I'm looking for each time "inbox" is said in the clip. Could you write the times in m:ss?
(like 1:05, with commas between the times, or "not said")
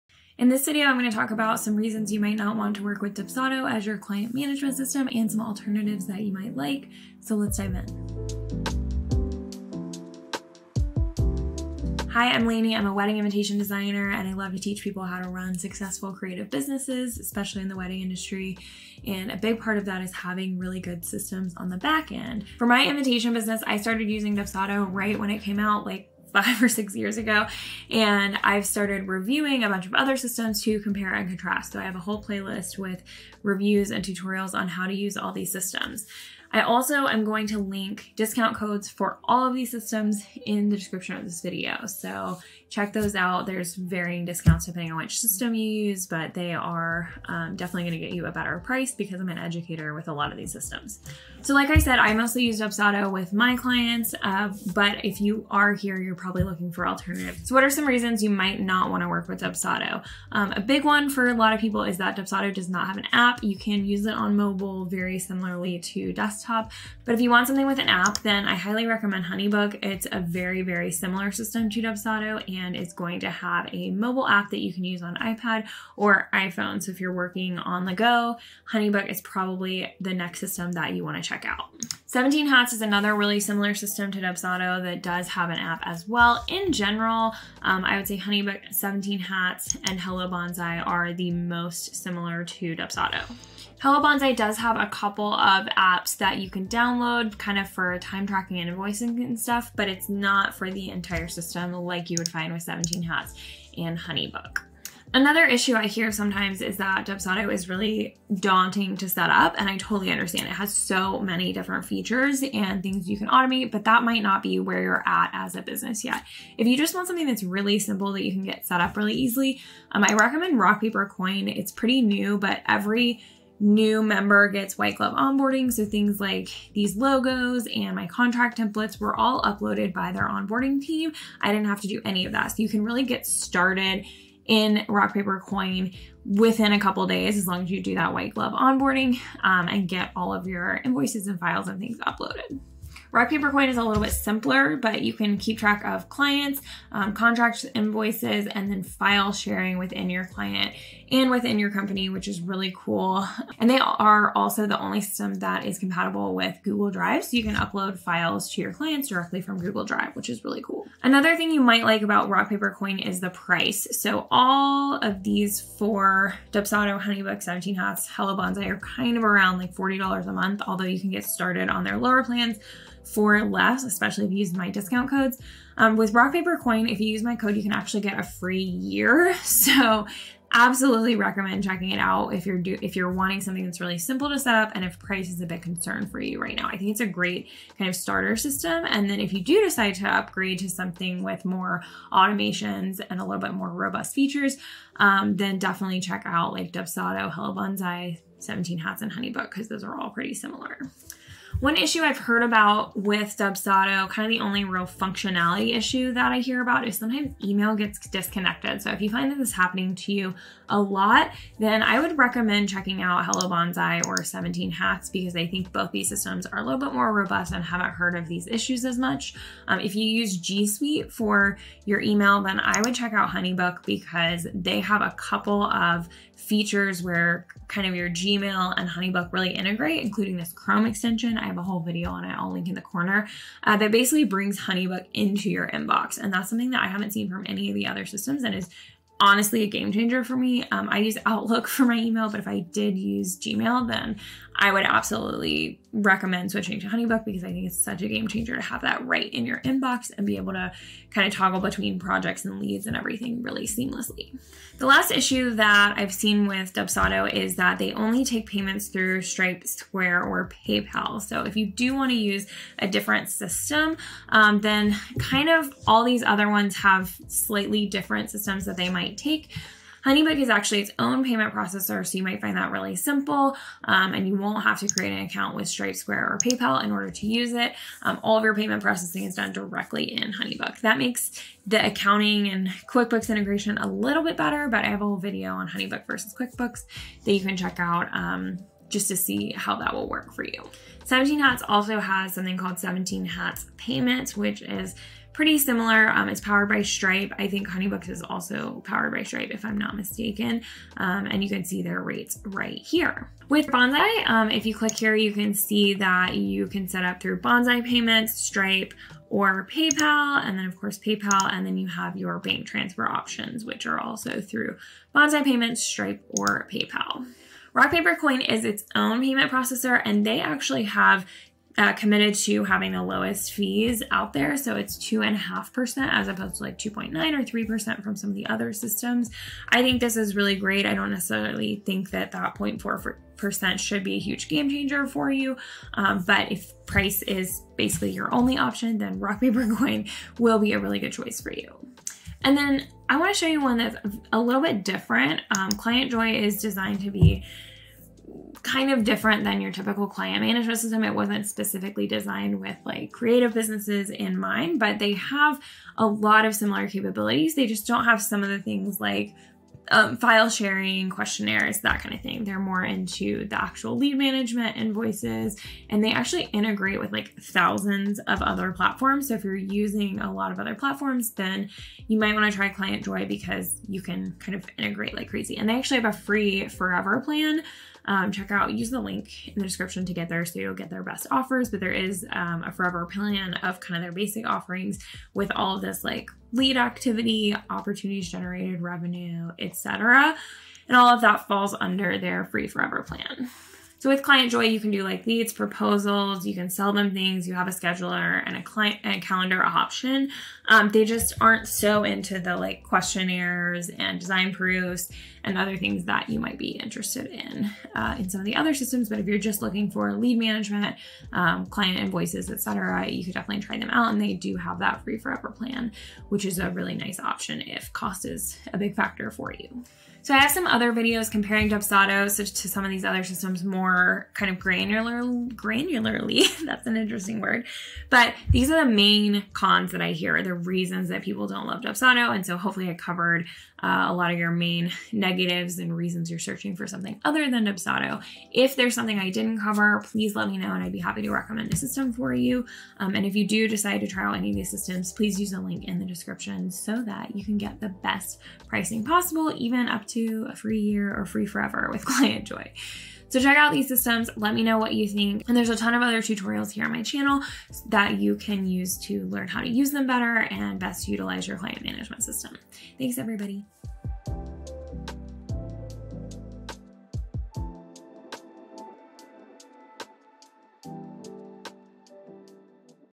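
3:55, 4:09.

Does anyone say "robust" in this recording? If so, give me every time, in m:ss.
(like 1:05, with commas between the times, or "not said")
3:13, 3:37.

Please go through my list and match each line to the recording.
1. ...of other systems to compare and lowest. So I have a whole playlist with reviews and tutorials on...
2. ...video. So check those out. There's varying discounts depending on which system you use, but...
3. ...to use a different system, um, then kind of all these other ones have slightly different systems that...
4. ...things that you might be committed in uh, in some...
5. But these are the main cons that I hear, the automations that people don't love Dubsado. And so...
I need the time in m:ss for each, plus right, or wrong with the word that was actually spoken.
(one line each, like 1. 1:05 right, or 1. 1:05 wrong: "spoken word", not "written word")
1. 0:29 wrong: "contrast", not "lowest"
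2. 0:41 right
3. 4:22 right
4. 6:45 wrong: "interested", not "committed"
5. 7:08 wrong: "reasons", not "automations".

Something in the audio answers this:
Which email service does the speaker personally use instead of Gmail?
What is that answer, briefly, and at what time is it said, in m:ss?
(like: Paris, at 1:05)
Outlook, at 4:01.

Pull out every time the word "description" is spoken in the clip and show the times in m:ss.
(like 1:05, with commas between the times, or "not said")
0:40, 6:19, 7:26.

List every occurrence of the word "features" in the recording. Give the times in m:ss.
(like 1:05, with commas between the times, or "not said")
1:51, 3:14, 3:46.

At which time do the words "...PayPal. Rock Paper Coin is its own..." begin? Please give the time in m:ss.
5:16.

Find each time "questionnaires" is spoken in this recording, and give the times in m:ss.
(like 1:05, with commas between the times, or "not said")
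6:01, 6:42.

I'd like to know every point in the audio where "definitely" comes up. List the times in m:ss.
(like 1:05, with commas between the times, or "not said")
0:47, 3:15, 6:53.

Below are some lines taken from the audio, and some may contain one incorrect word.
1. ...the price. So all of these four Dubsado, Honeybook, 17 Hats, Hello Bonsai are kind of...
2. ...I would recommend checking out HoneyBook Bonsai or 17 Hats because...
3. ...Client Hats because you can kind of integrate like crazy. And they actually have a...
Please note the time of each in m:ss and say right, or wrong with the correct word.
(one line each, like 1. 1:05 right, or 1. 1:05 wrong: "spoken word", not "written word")
1. 2:43 right
2. 3:31 wrong: "Hello", not "HoneyBook"
3. 6:12 wrong: "Joy", not "Hats".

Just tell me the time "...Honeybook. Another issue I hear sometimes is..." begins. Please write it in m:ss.
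1:43.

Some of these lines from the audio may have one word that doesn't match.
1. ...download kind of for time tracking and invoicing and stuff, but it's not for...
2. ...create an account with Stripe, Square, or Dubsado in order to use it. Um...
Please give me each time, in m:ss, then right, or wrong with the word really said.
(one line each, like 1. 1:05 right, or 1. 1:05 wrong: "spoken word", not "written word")
1. 1:36 right
2. 4:34 wrong: "PayPal", not "Dubsado".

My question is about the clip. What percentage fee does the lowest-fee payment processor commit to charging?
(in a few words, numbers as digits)
2.5%.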